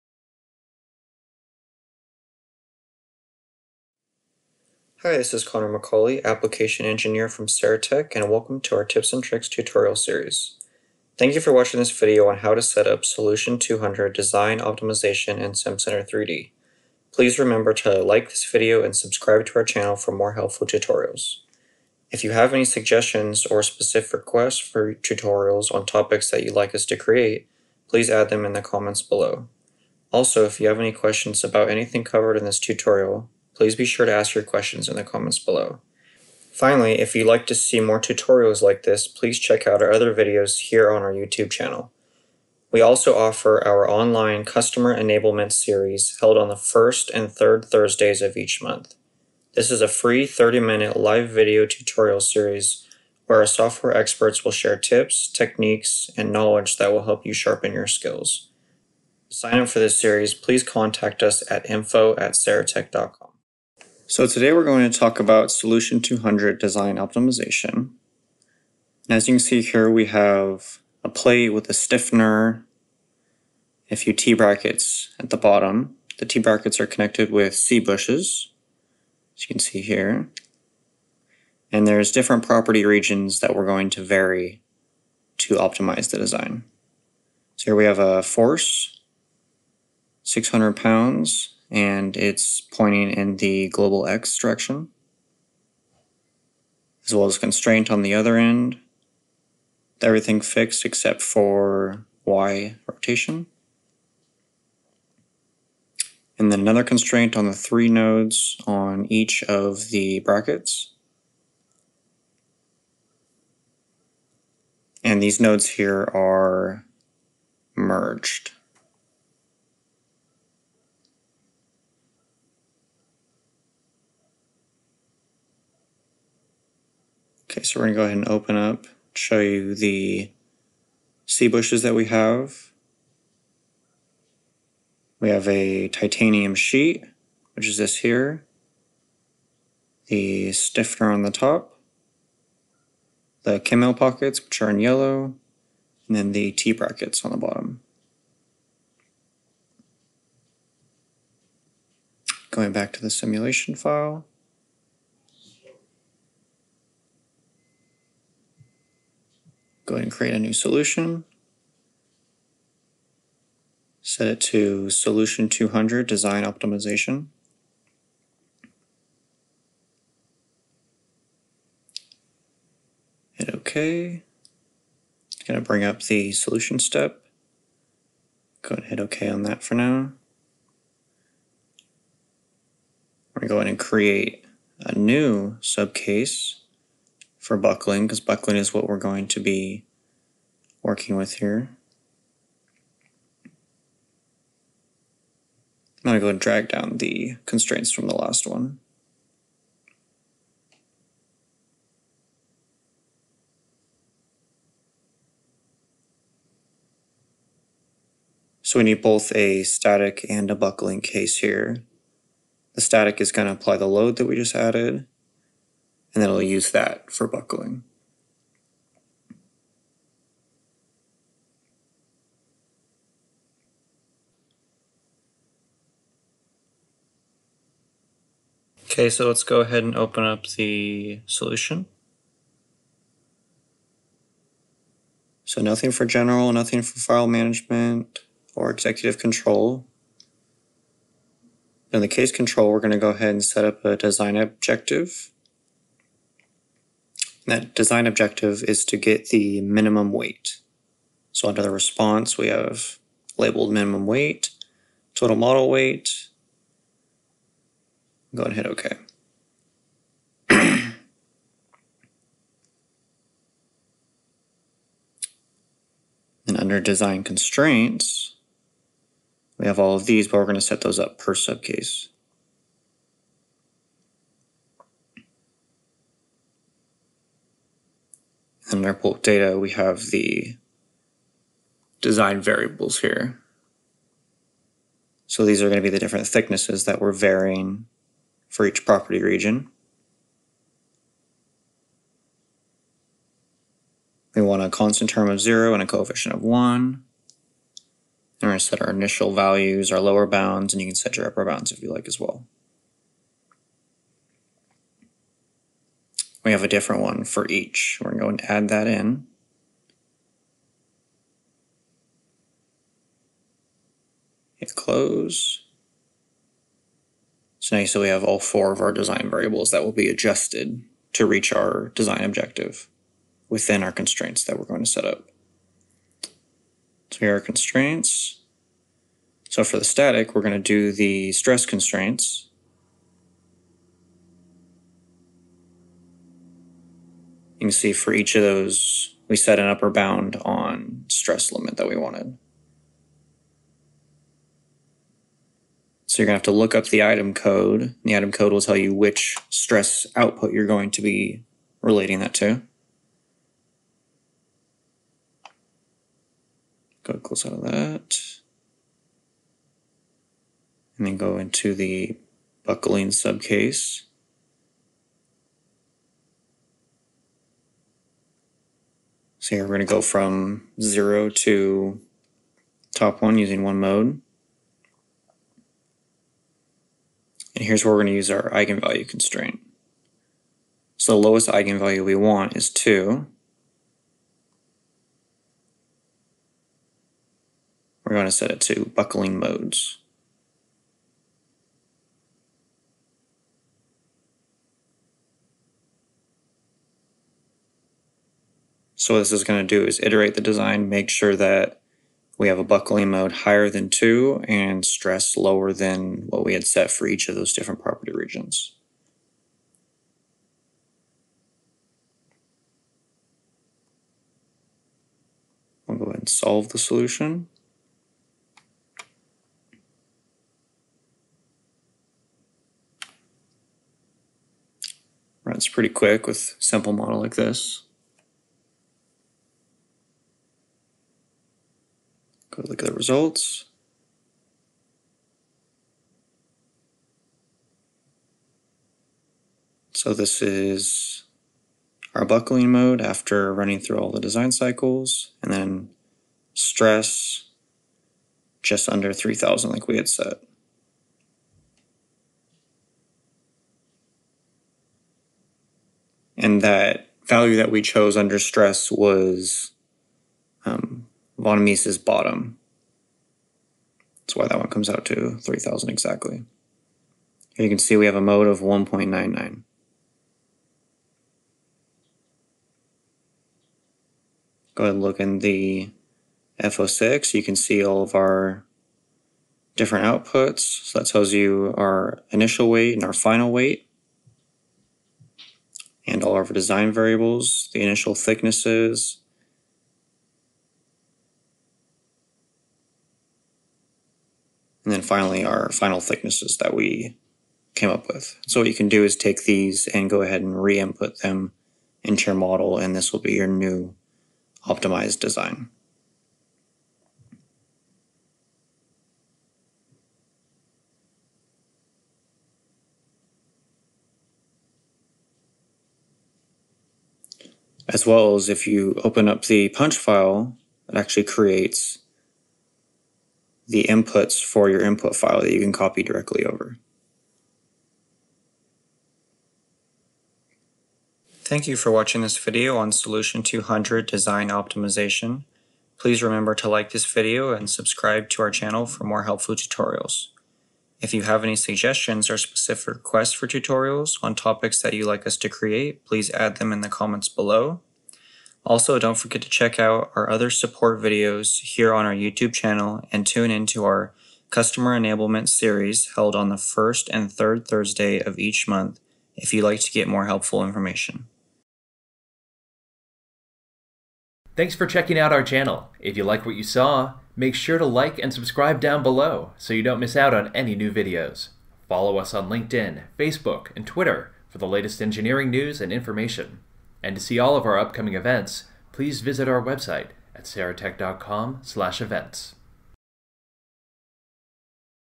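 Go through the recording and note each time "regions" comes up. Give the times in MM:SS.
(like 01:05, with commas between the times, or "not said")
01:22, 04:49, 06:48.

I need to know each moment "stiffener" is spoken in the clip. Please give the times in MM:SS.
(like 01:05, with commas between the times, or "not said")
01:11, 02:20.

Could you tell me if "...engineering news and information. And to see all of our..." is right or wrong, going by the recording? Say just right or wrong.
right.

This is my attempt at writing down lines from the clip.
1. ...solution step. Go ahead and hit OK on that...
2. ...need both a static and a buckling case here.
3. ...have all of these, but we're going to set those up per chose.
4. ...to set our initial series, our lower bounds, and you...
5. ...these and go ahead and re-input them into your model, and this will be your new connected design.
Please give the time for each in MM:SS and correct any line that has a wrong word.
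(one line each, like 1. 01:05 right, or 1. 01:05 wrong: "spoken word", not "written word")
1. 02:56 right
2. 03:28 right
3. 04:29 wrong: "subcase", not "chose"
4. 04:58 wrong: "values", not "series"
5. 08:19 wrong: "optimized", not "connected".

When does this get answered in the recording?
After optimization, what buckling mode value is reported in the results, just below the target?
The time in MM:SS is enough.
07:48.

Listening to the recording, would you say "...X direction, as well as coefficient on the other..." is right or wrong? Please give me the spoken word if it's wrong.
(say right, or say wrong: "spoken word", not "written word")
wrong: "constraint", not "coefficient".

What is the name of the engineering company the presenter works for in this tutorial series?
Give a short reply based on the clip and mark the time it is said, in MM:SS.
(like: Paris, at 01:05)
Saratech, at 00:07.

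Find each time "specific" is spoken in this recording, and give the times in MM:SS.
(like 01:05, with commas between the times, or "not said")
00:23, 09:02.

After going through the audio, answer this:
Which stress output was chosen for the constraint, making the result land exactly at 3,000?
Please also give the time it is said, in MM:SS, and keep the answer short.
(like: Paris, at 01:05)
Von Mises bottom, at 07:41.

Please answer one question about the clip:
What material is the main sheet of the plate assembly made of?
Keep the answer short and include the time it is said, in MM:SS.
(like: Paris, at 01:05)
Titanium, at 02:15.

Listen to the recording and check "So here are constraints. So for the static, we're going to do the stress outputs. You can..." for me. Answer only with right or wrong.
wrong.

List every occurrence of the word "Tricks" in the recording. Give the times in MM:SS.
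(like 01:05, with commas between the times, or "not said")
00:09.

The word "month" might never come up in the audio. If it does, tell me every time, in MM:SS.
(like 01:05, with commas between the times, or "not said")
00:48, 09:18.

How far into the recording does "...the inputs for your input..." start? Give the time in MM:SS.
08:43.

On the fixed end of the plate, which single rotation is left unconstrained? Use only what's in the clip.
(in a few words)
Y rotation.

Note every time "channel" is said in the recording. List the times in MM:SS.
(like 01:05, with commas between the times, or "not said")
00:19, 00:41, 08:58, 09:12, 09:25.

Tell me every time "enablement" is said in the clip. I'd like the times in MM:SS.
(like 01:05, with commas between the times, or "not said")
00:44, 09:14.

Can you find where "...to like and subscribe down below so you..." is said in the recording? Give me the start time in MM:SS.
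09:27.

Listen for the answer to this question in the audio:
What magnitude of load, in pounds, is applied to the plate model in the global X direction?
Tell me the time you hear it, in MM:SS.
01:30.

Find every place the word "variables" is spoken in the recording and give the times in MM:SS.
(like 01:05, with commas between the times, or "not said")
04:42, 05:19, 08:06.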